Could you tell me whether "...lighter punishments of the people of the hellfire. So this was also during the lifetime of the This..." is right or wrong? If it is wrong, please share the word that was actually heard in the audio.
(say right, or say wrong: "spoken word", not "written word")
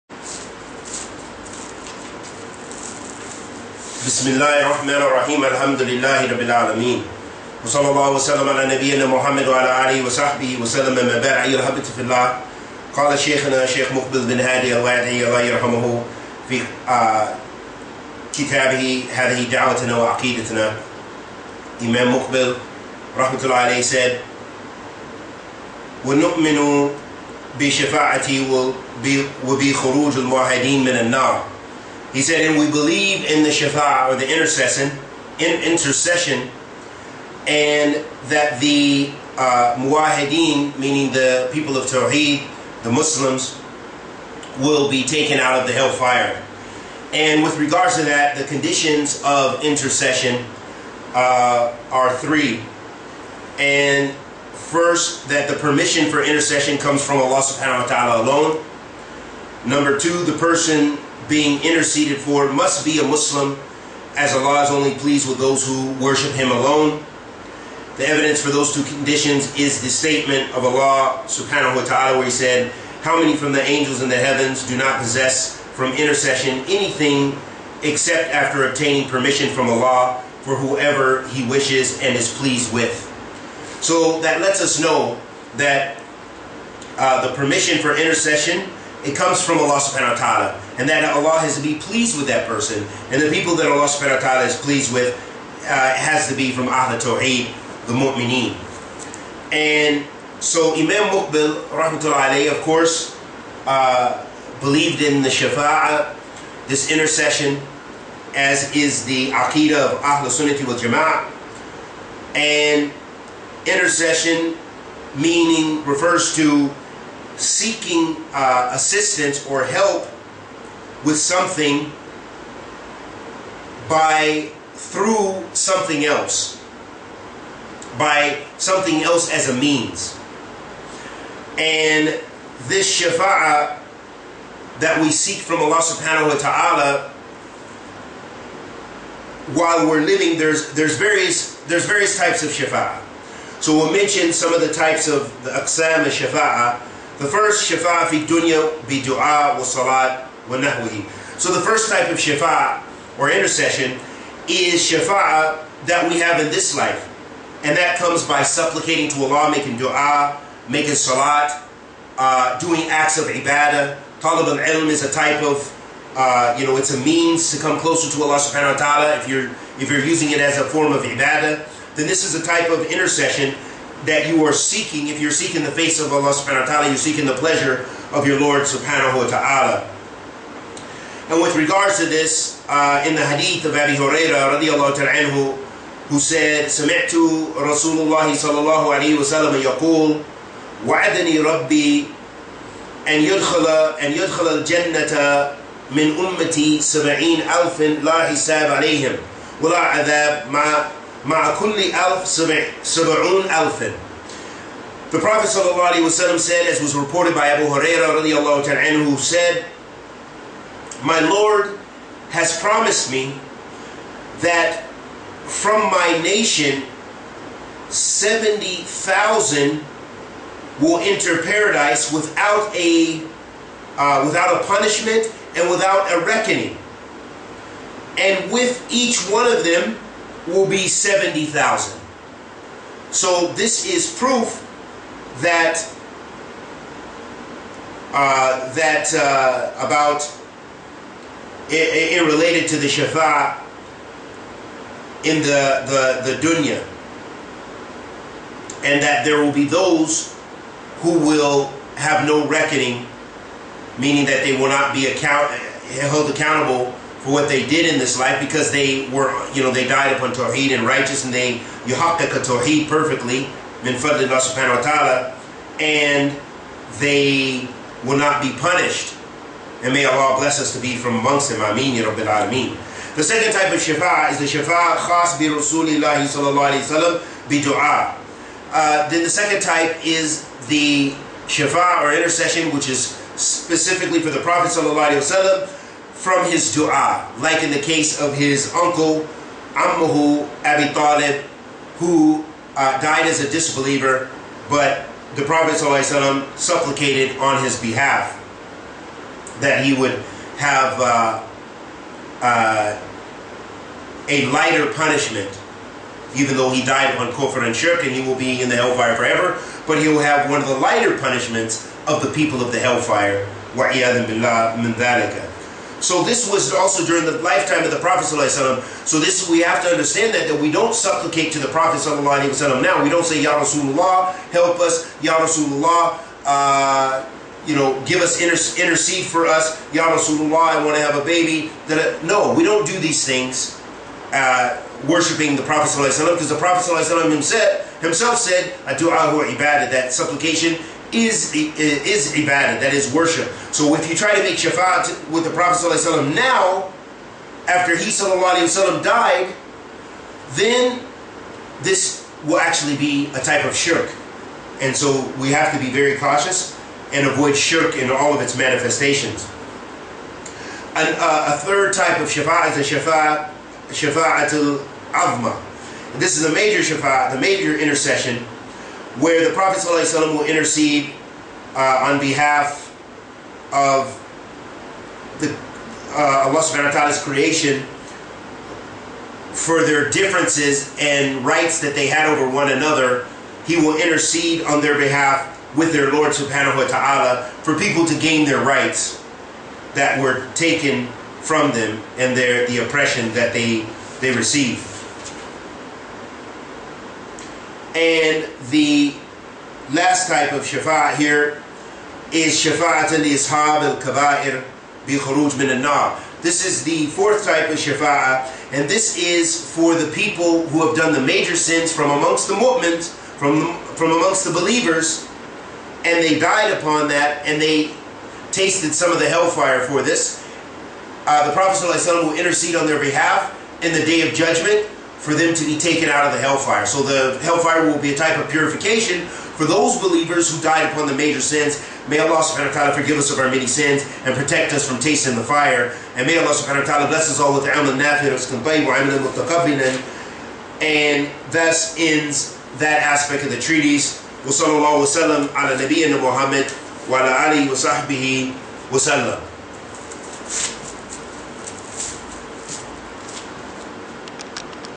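wrong: "Prophet", not "This".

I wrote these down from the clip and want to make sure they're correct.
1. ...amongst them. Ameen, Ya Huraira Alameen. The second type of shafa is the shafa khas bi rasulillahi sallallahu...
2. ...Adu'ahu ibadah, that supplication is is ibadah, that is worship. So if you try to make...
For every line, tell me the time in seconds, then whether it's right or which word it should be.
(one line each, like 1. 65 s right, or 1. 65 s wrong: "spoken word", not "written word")
1. 271 s wrong: "Rabbil", not "Huraira"
2. 338 s right.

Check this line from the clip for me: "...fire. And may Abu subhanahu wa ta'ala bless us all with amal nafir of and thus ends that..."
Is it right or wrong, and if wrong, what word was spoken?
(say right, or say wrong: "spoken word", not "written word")
wrong: "Allah", not "Abu".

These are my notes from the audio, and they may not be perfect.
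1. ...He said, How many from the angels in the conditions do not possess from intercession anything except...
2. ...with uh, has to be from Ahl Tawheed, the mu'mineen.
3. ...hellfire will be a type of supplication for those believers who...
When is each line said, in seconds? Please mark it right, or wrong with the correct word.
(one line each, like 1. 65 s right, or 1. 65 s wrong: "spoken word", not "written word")
1. 72 s wrong: "heavens", not "conditions"
2. 94 s right
3. 427 s wrong: "purification", not "supplication".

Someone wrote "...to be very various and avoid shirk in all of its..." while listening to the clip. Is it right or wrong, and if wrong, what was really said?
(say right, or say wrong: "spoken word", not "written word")
wrong: "cautious", not "various".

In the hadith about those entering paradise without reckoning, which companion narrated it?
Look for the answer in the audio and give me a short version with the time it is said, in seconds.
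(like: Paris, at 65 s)
Abu Hurairah, at 183 s.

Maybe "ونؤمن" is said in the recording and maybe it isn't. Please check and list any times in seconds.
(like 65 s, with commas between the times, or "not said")
26 s.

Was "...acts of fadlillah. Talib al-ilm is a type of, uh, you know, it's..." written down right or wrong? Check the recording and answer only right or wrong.
wrong.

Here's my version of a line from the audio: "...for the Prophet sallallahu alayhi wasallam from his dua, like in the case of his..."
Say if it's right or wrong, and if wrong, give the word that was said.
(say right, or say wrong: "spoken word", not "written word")
right.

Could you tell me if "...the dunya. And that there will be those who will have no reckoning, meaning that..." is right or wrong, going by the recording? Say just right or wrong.
right.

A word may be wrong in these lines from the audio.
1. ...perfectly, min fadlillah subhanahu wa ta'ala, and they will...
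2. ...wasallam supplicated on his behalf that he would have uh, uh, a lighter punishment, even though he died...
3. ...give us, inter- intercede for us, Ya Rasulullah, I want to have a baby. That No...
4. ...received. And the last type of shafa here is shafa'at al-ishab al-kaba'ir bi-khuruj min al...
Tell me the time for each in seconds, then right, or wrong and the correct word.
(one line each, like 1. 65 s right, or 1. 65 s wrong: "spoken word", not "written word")
1. 262 s right
2. 296 s right
3. 328 s right
4. 394 s right.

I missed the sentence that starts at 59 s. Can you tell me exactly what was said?
Number two, the person being interceded for must be a Muslim, as Allah is only pleased with those who worship Him alone.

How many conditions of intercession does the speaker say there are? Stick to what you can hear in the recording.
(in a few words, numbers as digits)
3.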